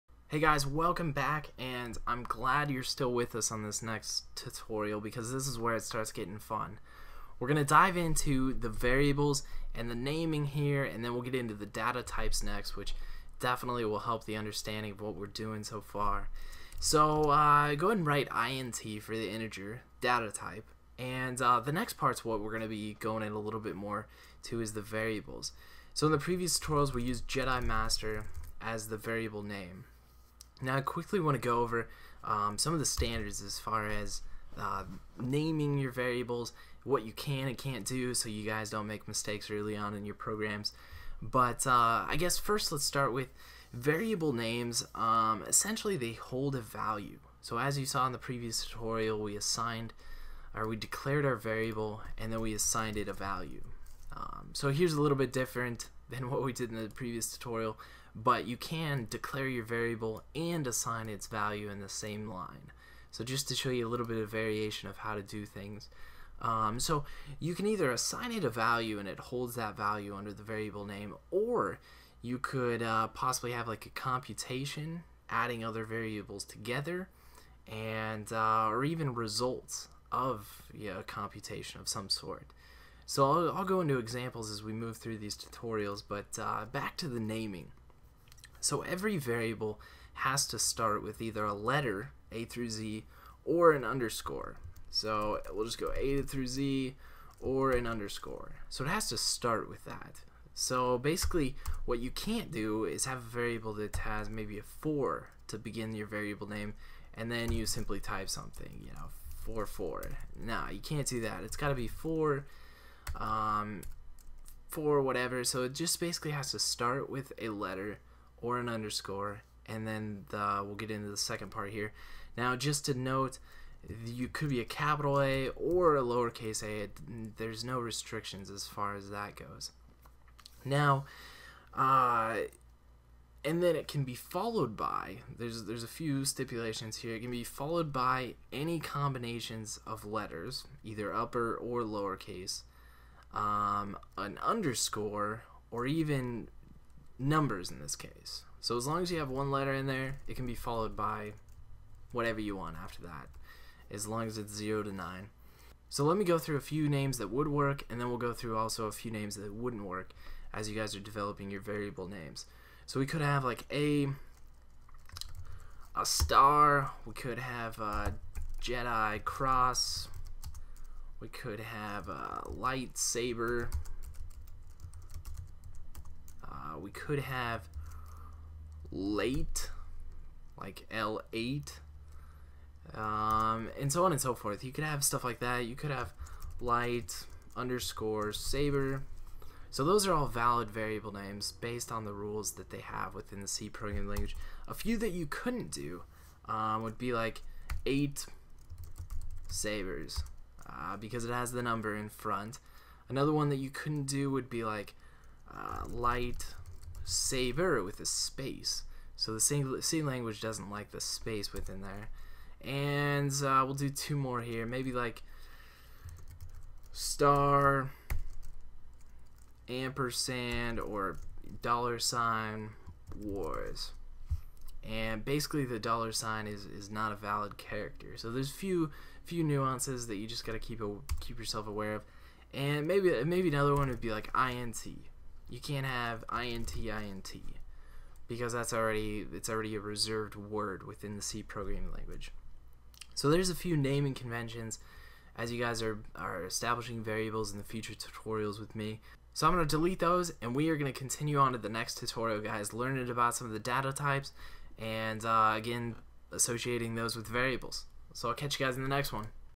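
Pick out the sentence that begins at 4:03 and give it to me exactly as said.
So there's a few naming conventions as you guys are are establishing variables in the future tutorials with me.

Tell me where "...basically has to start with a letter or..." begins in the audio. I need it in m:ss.
1:55.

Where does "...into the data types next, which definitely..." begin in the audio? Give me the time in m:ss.
0:11.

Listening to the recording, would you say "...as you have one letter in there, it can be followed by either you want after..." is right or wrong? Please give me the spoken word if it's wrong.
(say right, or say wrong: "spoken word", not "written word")
wrong: "whatever", not "either".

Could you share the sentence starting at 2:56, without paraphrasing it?
Uh, we could have late, like L8, um, and so on and so forth.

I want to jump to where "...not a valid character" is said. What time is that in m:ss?
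3:46.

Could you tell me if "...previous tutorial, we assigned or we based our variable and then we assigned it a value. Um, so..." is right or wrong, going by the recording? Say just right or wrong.
wrong.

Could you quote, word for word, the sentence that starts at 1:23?
So I'll, I'll, go into examples as we move through these tutorials, but uh, back to the naming.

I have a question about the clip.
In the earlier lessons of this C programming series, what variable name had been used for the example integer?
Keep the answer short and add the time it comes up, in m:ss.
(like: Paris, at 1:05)
Jedi Master, at 0:27.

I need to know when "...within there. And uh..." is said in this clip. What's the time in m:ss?
3:31.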